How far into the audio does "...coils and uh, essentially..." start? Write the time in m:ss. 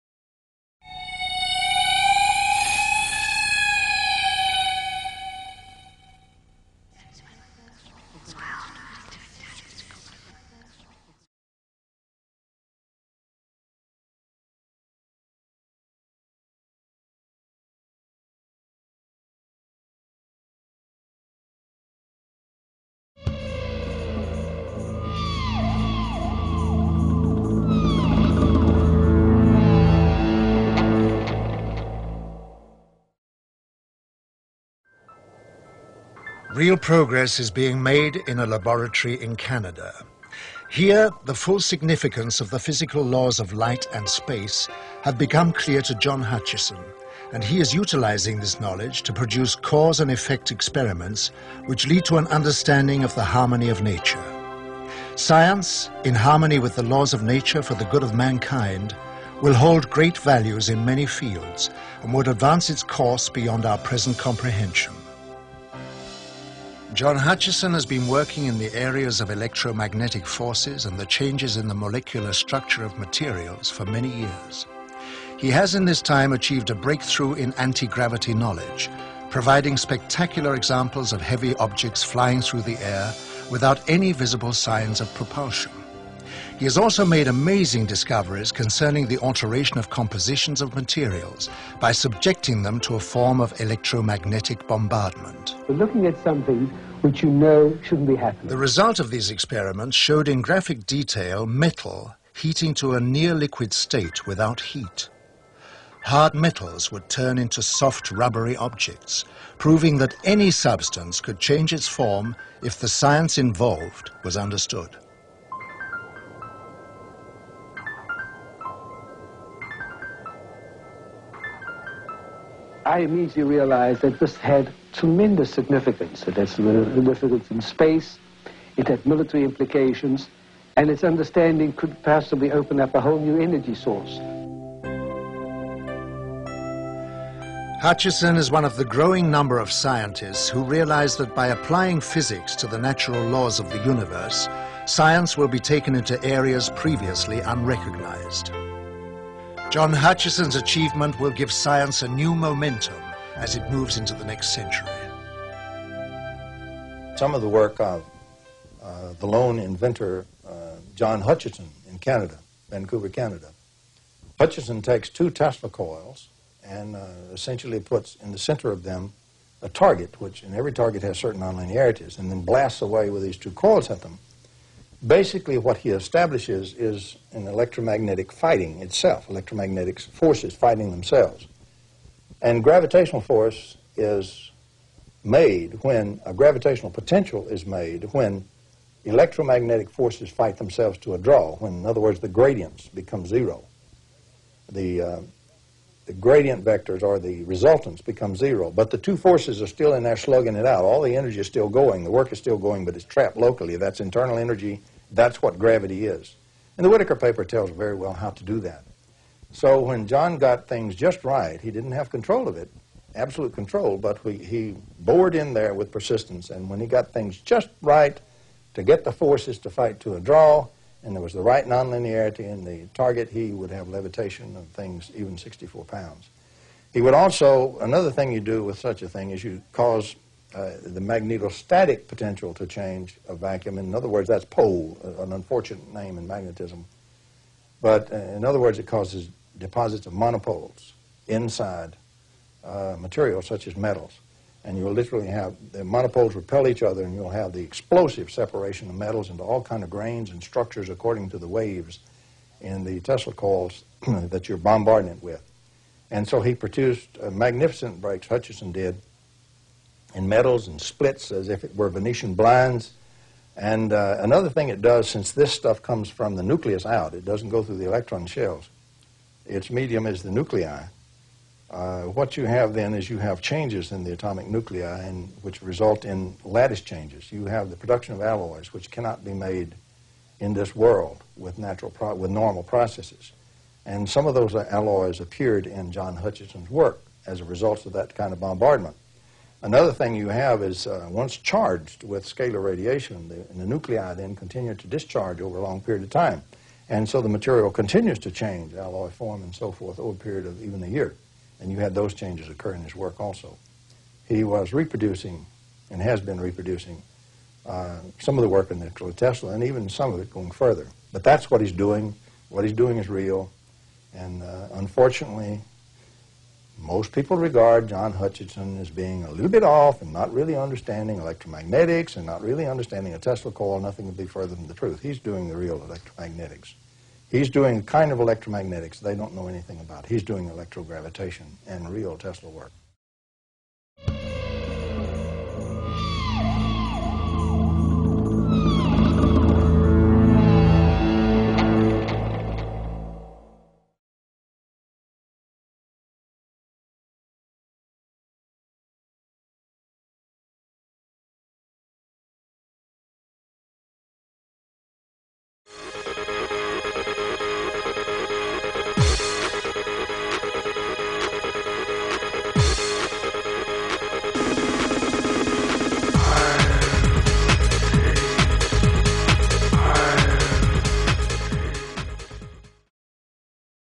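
2:45.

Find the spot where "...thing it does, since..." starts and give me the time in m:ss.
4:24.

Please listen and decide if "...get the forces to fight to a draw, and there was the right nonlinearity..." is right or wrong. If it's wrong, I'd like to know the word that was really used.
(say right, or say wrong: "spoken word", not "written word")
right.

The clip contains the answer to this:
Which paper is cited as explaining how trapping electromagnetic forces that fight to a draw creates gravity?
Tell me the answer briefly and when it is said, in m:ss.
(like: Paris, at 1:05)
Whittaker paper, at 3:26.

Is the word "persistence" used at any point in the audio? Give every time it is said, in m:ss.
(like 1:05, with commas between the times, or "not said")
3:35.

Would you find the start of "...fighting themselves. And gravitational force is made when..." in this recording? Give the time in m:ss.
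3:00.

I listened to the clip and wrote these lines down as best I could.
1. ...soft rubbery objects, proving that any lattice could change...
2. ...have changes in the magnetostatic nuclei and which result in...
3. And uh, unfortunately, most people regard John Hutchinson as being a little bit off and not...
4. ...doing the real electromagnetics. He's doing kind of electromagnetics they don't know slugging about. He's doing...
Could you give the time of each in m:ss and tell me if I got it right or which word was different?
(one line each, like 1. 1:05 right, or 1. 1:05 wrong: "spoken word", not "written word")
1. 1:47 wrong: "substance", not "lattice"
2. 4:33 wrong: "atomic", not "magnetostatic"
3. 5:14 right
4. 5:25 wrong: "anything", not "slugging".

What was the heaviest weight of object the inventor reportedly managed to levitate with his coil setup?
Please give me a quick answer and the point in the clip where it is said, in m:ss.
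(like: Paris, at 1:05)
64 pounds, at 3:45.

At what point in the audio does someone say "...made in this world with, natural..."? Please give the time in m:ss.
4:39.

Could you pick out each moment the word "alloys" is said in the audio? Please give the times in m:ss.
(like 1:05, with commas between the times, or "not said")
4:38, 4:44, 4:58.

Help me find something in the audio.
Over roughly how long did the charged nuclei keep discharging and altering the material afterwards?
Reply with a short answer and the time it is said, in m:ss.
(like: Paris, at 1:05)
a year, at 5:00.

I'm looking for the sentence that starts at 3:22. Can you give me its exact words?
The work is still going, but it's trapped locally.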